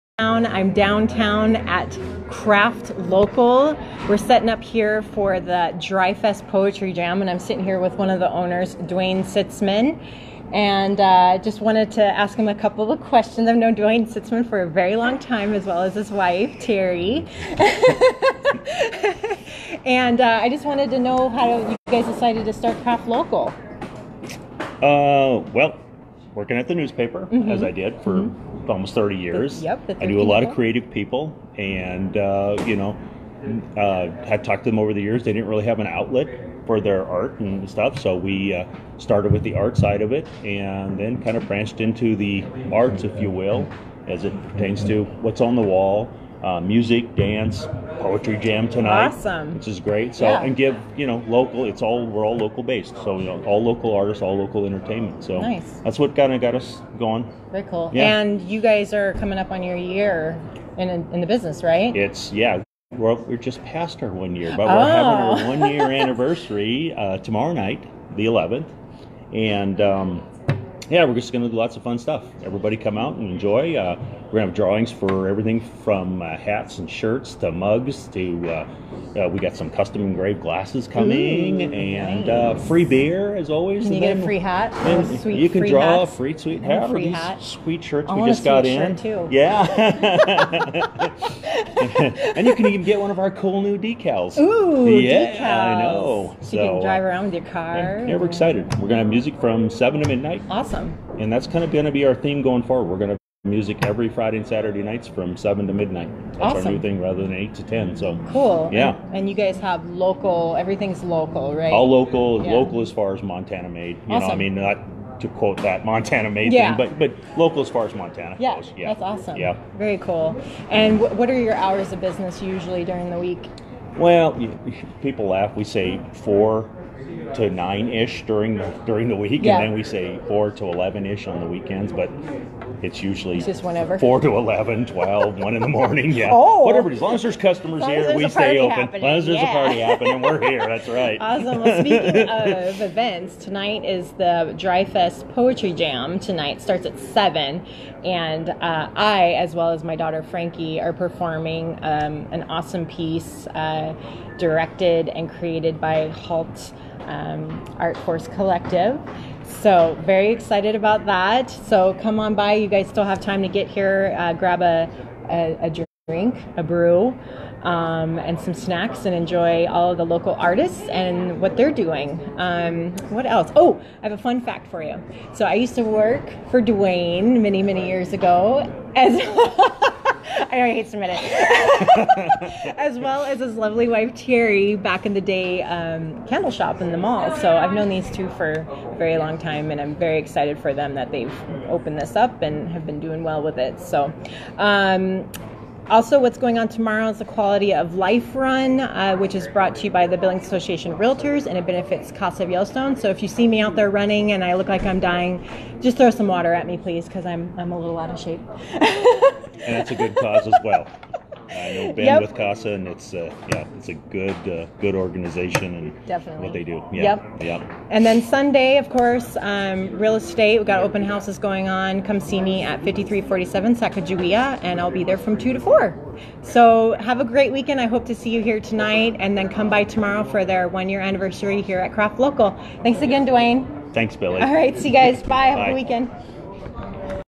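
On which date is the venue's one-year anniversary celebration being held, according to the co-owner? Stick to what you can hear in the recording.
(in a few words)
the 11th.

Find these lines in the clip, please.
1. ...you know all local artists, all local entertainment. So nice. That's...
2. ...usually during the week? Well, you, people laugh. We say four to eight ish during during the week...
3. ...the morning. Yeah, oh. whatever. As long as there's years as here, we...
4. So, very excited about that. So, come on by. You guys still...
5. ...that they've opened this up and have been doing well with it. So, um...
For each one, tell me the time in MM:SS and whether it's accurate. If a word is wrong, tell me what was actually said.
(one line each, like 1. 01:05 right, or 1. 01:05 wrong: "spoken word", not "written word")
1. 00:53 right
2. 02:02 wrong: "nine", not "eight"
3. 02:15 wrong: "customers", not "years"
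4. 02:39 right
5. 03:10 right.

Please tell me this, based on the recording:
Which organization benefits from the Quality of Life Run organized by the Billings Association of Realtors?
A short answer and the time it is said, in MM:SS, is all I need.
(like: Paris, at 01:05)
Casa of Yellowstone, at 03:22.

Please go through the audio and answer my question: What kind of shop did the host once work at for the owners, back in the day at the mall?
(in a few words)
candle shop.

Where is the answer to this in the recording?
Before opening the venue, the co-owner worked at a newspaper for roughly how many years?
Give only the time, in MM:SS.
00:28.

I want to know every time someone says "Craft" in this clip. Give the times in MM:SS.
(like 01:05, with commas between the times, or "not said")
00:02, 00:22, 03:51.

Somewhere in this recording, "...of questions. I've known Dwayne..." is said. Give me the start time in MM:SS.
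00:12.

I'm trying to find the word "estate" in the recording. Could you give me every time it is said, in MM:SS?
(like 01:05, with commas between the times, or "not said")
03:40.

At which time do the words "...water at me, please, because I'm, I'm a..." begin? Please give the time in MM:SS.
03:26.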